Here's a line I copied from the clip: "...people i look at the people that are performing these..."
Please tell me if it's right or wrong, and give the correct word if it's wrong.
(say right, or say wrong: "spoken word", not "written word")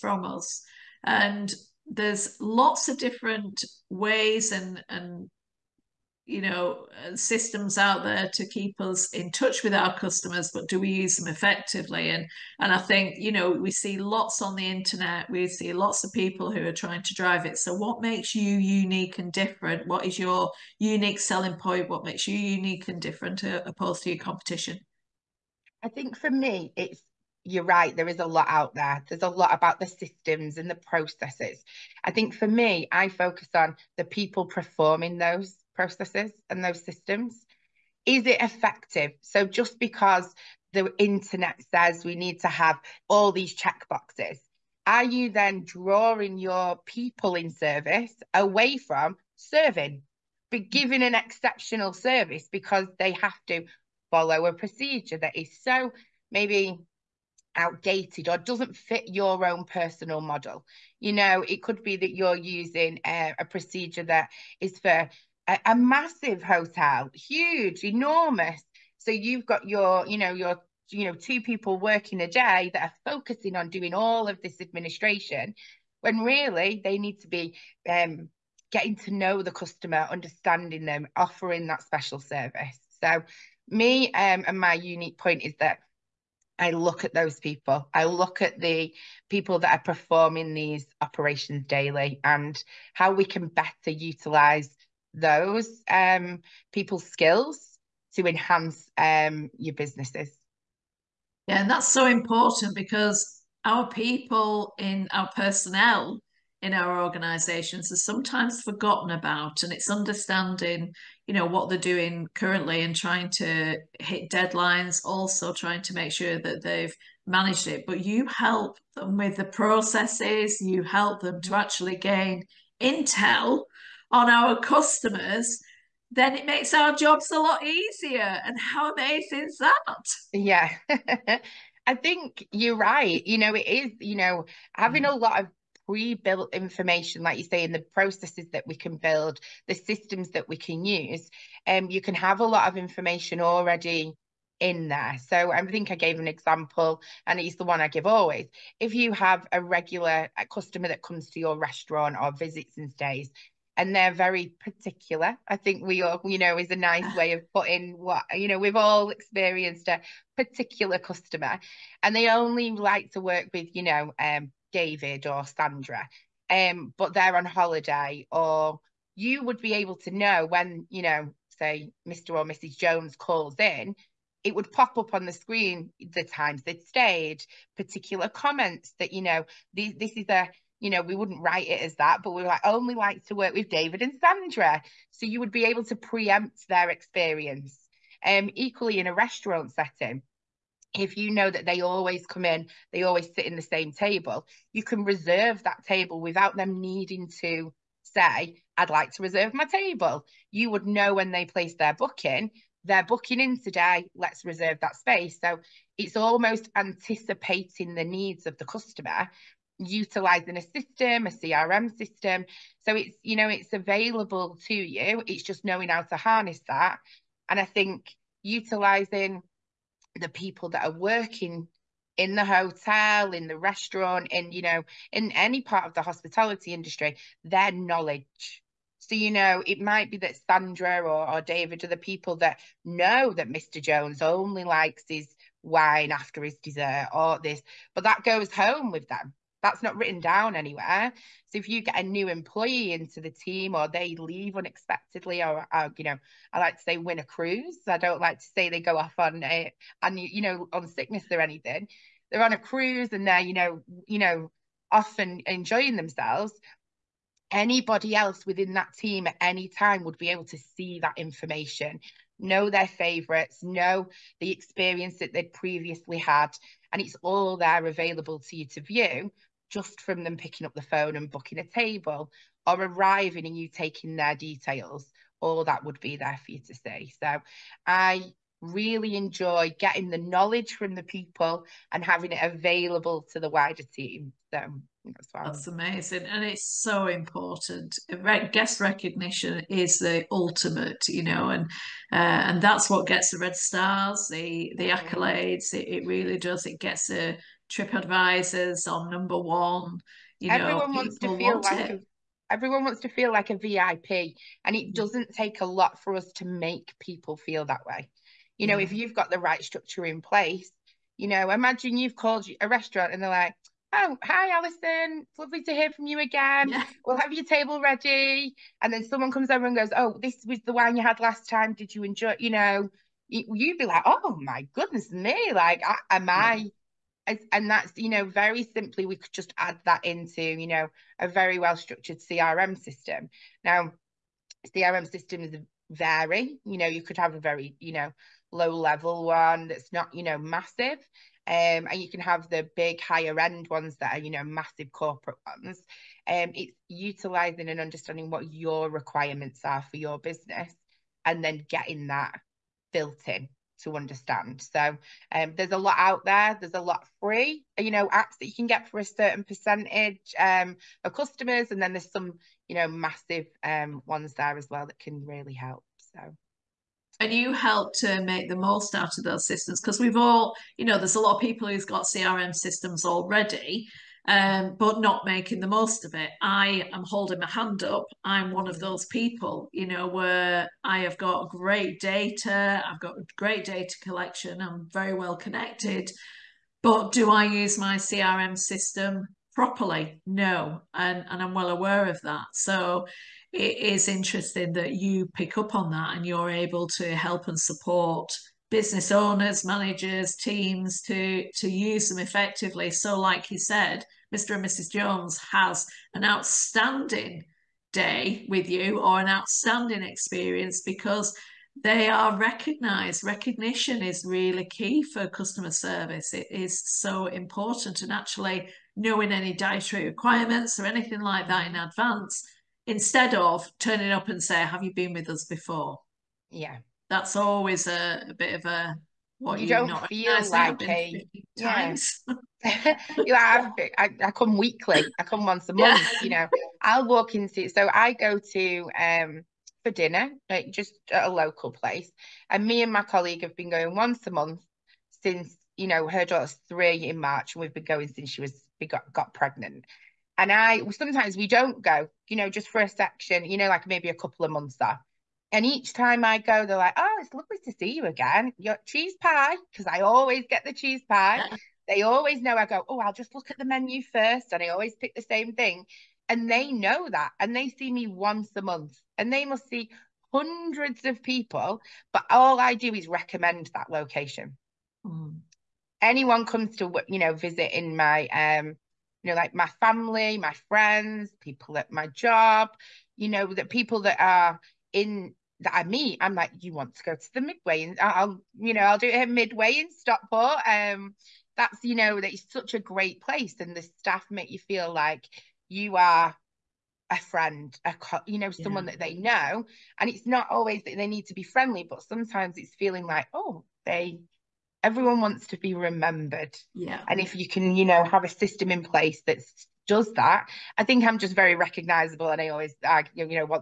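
right.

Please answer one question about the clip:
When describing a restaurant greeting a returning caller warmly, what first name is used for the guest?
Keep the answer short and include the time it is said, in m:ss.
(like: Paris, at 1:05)
Alison, at 5:14.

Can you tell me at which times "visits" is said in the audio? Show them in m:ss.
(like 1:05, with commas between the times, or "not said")
2:32, 7:57.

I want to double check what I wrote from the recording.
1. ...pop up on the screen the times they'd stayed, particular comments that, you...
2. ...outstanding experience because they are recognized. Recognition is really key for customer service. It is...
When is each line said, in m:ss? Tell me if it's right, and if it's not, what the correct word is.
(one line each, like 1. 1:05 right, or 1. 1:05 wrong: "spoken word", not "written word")
1. 2:54 right
2. 6:49 right.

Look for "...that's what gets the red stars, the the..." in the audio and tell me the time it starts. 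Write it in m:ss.
4:52.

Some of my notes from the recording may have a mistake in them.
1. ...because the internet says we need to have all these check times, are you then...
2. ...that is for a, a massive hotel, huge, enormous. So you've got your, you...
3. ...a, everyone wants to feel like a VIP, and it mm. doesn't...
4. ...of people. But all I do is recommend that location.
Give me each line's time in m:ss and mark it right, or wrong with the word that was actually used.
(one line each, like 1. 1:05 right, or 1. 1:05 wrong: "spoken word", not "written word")
1. 0:39 wrong: "boxes", not "times"
2. 1:04 right
3. 5:01 right
4. 7:51 right.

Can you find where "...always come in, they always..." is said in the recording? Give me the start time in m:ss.
3:11.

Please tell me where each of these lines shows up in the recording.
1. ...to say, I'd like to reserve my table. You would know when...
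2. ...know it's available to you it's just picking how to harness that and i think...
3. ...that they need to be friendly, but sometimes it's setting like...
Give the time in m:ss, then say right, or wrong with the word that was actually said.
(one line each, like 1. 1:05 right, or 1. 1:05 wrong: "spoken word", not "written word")
1. 3:17 right
2. 3:33 wrong: "knowing", not "picking"
3. 8:20 wrong: "feeling", not "setting".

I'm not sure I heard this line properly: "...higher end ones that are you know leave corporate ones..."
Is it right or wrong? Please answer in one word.
wrong.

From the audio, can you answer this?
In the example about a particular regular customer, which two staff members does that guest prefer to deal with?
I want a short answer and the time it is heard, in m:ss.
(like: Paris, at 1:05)
David and Sandra, at 2:44.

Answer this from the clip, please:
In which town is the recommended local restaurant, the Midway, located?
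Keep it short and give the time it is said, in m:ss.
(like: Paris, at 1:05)
Stockport, at 8:09.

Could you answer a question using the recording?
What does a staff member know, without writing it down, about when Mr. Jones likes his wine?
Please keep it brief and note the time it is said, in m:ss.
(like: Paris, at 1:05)
After his dessert, at 3:56.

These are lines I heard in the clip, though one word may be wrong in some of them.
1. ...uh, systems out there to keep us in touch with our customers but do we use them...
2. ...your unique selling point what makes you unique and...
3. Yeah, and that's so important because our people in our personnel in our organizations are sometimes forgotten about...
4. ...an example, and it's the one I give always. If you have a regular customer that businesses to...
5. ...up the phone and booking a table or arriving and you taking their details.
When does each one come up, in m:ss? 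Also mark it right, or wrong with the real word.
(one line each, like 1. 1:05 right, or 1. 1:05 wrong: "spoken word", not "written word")
1. 0:07 right
2. 0:20 right
3. 1:41 right
4. 2:26 wrong: "comes", not "businesses"
5. 4:30 right.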